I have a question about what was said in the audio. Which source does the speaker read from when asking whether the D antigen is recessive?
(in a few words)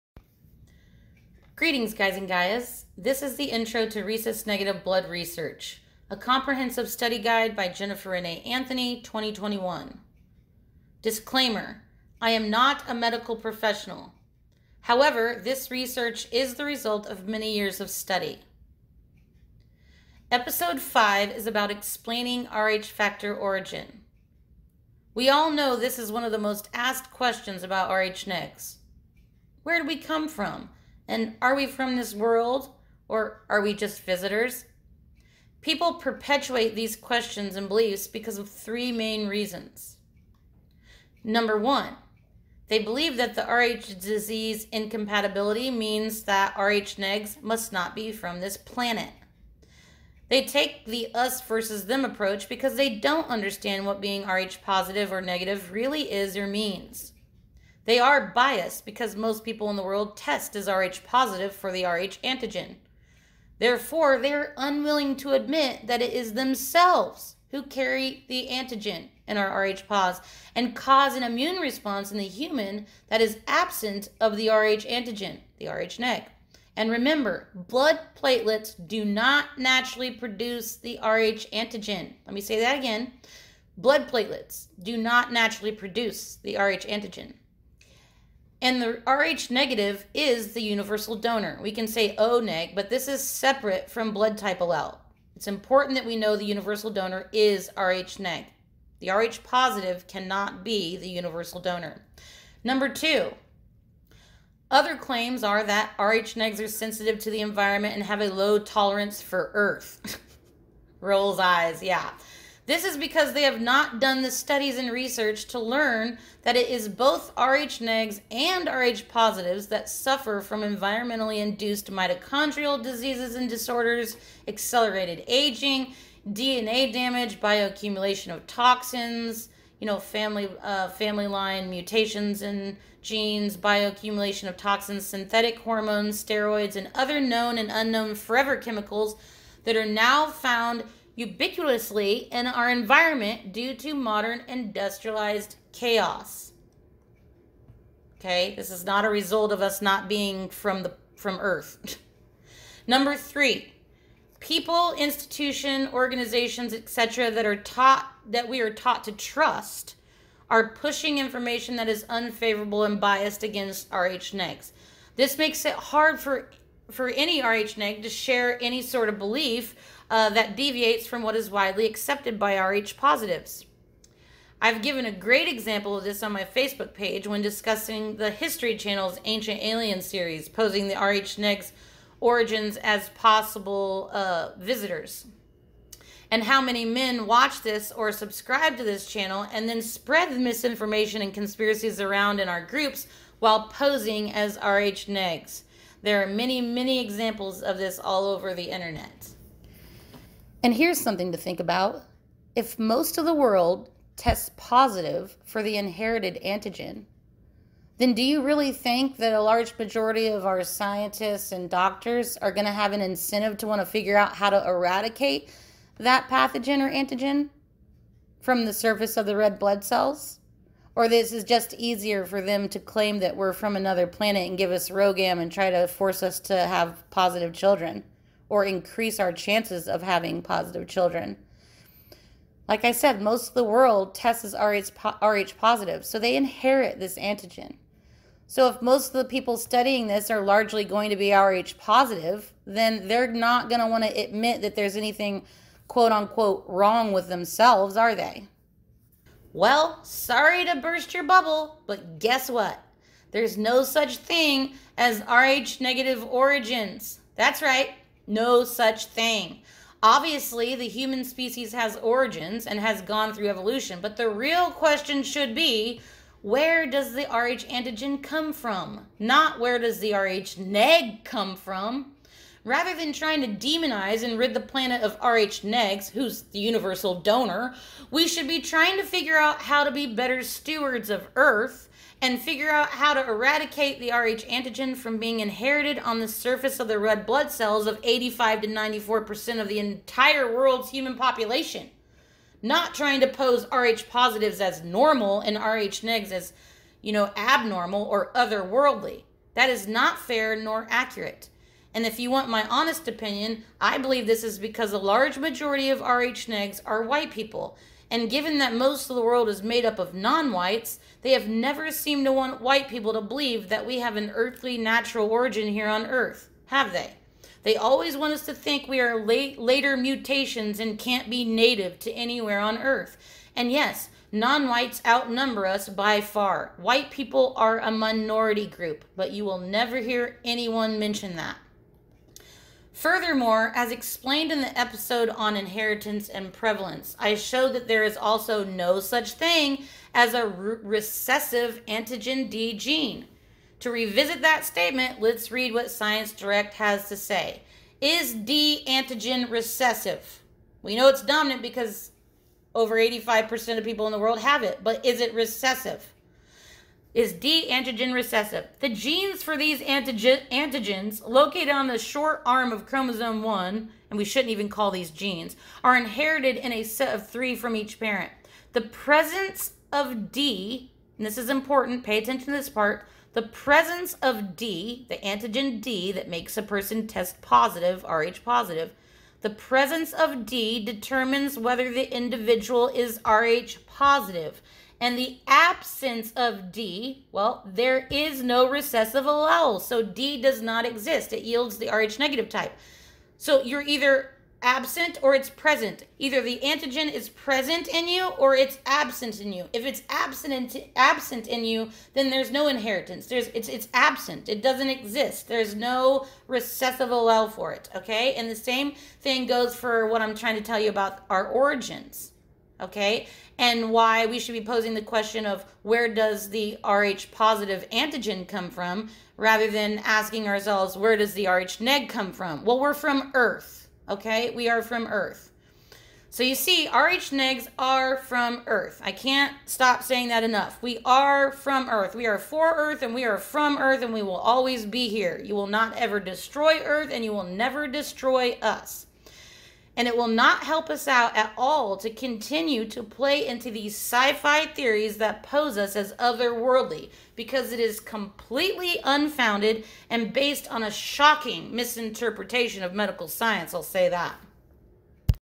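Science Direct.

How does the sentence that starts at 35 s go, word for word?
People perpetuate these questions and beliefs because of three main reasons.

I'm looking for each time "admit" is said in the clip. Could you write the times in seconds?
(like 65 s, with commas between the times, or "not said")
65 s, 244 s.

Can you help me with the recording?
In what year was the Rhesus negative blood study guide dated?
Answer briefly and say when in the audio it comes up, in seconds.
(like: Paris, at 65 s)
2021, at 9 s.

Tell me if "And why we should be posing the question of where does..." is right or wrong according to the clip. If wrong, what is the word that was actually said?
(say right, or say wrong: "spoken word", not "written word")
right.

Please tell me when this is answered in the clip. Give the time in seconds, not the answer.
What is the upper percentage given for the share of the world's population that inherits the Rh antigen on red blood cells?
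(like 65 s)
288 s.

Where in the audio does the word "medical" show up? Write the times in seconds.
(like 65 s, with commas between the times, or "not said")
12 s, 452 s.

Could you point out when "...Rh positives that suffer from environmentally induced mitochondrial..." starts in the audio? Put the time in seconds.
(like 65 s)
118 s.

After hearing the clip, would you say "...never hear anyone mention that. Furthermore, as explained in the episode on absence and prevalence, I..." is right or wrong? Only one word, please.
wrong.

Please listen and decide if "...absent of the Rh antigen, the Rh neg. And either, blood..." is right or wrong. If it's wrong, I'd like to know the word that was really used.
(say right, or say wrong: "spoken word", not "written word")
wrong: "remember", not "either".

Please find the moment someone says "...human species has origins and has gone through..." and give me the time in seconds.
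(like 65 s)
260 s.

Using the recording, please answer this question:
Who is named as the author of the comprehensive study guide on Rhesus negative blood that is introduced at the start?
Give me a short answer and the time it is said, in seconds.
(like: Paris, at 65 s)
Jennifer Renee Anthony, at 7 s.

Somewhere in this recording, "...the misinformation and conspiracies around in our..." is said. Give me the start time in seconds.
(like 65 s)
190 s.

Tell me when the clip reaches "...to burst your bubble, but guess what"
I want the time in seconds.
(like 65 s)
250 s.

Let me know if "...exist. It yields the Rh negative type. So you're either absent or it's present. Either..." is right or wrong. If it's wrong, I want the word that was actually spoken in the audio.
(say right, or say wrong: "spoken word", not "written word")
right.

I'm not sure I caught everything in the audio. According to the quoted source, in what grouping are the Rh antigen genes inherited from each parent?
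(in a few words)
A set of three.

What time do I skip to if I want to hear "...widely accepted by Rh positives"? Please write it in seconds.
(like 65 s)
171 s.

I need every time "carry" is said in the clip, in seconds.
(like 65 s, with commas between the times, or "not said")
67 s.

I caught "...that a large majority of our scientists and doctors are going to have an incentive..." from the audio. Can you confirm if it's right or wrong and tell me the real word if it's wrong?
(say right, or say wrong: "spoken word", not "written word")
right.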